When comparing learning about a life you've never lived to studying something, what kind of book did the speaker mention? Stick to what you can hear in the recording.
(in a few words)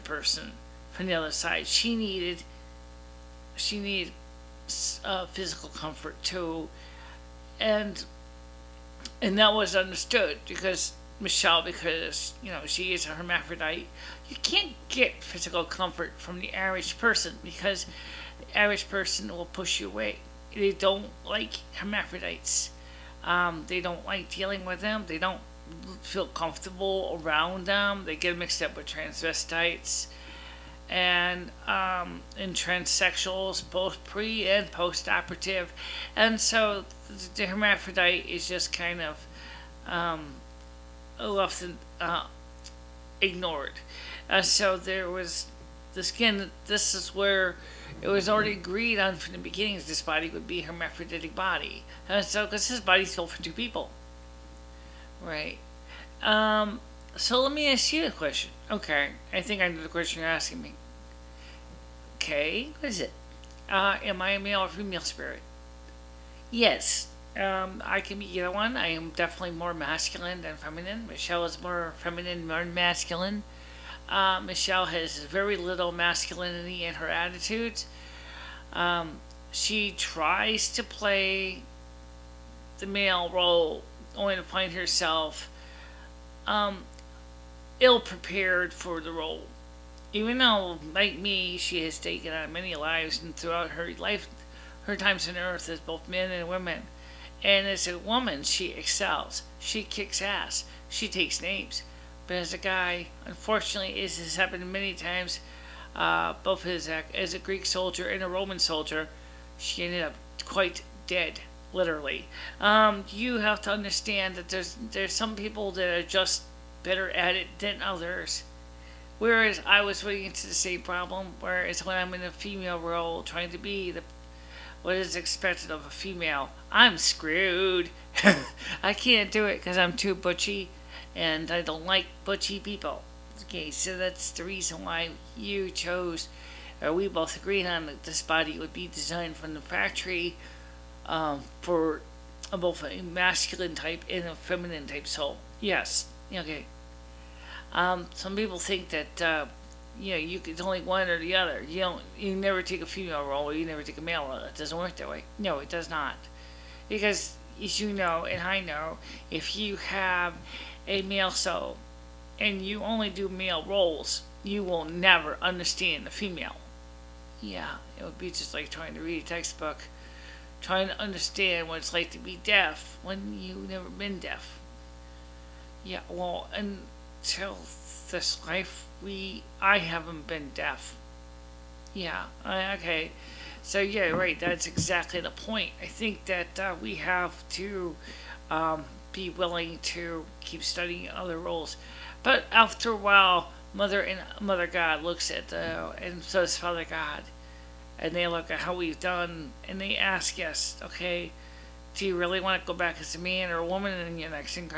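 textbook.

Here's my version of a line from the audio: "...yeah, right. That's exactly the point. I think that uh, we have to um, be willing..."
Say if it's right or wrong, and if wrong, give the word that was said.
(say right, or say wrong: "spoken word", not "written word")
right.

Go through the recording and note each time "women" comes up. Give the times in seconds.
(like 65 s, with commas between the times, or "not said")
96 s.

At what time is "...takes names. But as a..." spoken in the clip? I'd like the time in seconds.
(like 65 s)
101 s.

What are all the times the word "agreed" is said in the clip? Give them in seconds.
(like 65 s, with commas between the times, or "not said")
48 s, 137 s.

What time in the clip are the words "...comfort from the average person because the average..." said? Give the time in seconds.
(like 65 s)
15 s.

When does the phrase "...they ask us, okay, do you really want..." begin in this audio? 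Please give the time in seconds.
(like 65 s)
199 s.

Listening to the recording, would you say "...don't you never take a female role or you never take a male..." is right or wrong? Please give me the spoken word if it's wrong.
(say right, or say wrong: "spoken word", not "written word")
right.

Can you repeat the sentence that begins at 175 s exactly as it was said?
Yeah, well, and till this life we I haven't been deaf.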